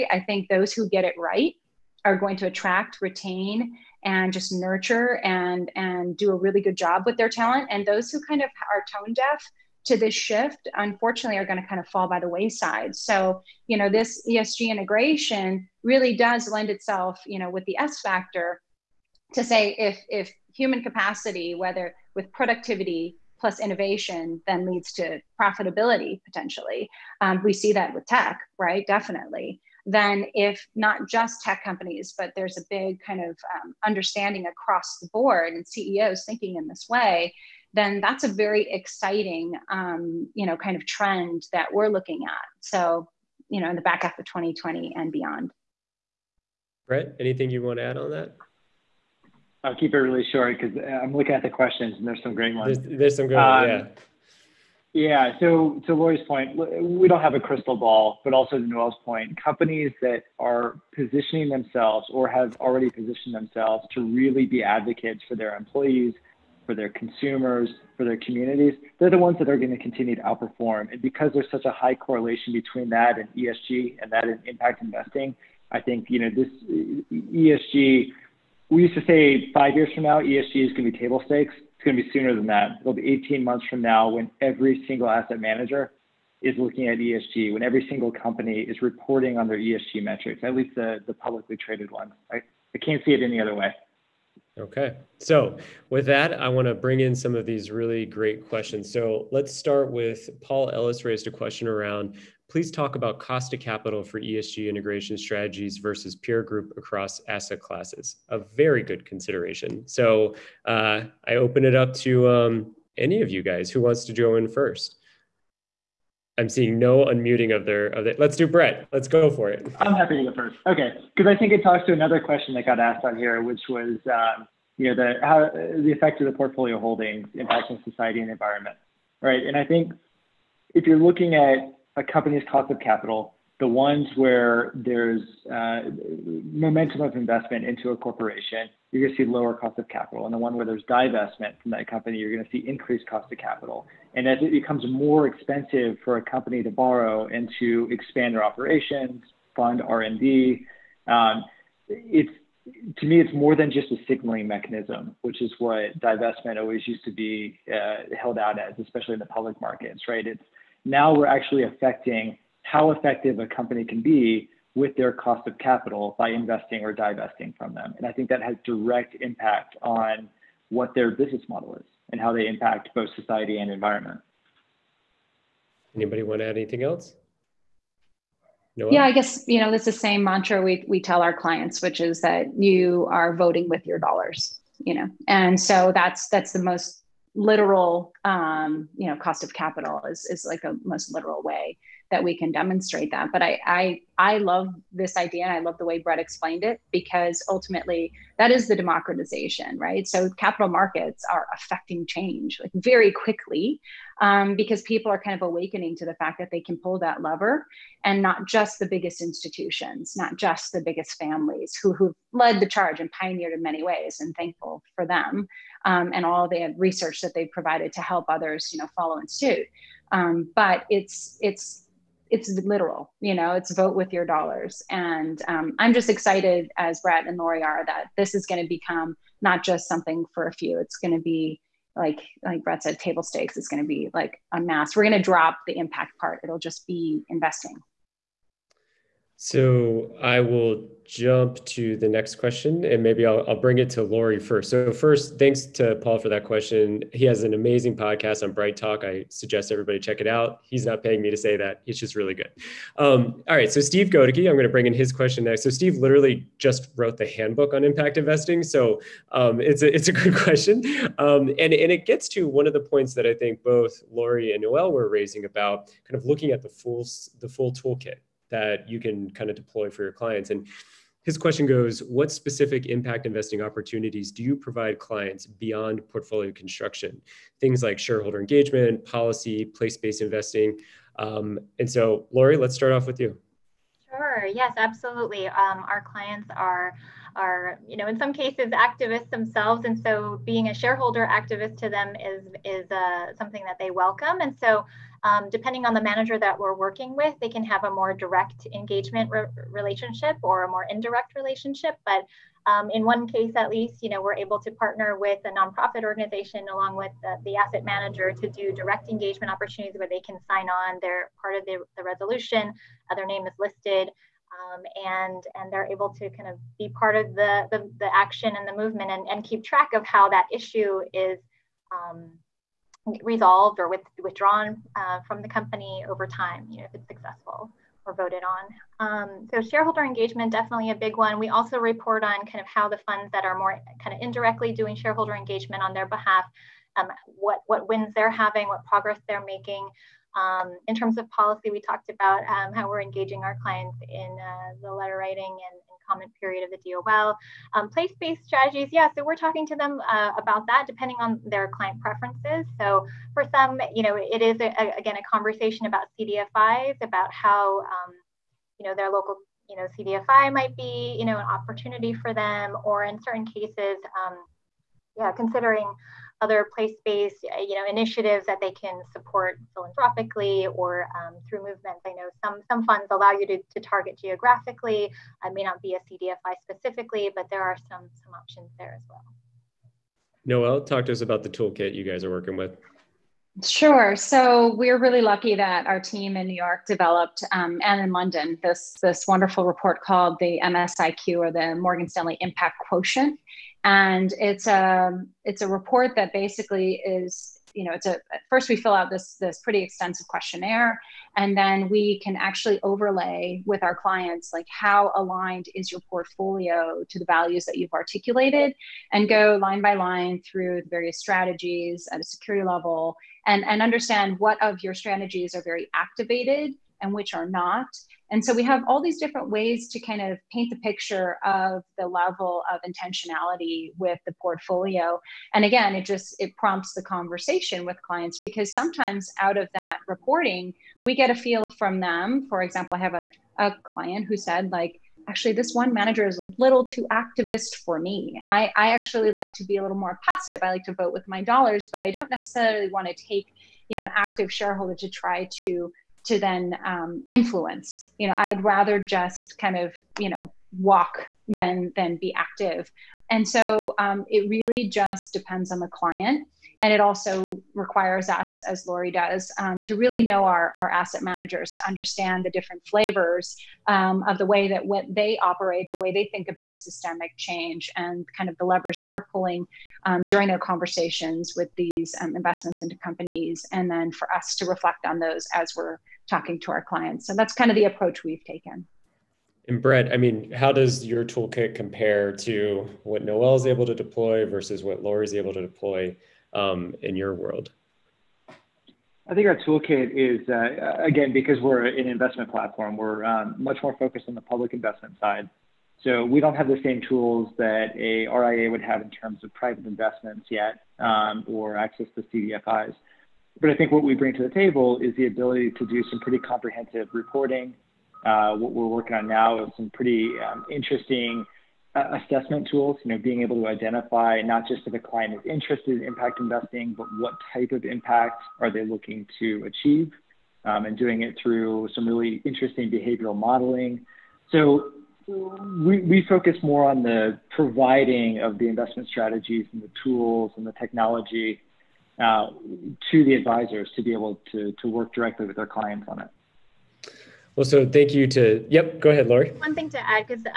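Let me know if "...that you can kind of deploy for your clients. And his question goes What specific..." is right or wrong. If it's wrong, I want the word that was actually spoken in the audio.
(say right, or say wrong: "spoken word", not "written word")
right.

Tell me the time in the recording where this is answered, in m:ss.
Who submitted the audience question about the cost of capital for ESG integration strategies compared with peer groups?
1:40.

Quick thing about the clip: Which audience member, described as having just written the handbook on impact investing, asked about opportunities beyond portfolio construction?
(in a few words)
Steve Godeke.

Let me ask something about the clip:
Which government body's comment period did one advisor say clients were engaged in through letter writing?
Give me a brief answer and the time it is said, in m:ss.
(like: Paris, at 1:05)
DOL, at 5:46.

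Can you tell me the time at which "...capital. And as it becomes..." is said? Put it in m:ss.
2:23.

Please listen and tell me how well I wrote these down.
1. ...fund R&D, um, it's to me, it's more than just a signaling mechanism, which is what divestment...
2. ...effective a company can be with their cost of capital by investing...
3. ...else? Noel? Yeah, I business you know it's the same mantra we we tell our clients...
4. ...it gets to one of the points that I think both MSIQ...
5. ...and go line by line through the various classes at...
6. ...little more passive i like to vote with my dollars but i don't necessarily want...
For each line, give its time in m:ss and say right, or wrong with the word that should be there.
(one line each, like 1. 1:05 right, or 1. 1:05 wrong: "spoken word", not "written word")
1. 2:29 right
2. 2:42 right
3. 2:56 wrong: "guess", not "business"
4. 4:21 wrong: "Lori", not "MSIQ"
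5. 6:49 wrong: "strategies", not "classes"
6. 7:19 right.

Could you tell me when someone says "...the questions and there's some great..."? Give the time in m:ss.
0:51.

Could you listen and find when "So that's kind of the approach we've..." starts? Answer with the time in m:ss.
7:57.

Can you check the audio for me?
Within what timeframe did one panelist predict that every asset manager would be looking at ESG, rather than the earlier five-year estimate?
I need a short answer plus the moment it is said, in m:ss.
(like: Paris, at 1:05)
18 months, at 1:23.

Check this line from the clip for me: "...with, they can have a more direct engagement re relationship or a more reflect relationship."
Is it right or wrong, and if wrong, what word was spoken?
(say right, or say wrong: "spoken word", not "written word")
wrong: "indirect", not "reflect".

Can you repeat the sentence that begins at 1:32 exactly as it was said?
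I, I can't see it any other way.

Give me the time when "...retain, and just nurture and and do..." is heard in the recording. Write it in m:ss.
0:03.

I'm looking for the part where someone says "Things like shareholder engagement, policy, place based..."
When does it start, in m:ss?
4:37.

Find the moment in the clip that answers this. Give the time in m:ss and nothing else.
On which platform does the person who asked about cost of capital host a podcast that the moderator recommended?
4:08.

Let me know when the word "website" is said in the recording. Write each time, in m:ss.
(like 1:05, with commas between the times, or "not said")
not said.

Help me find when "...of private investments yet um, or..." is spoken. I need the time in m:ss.
8:19.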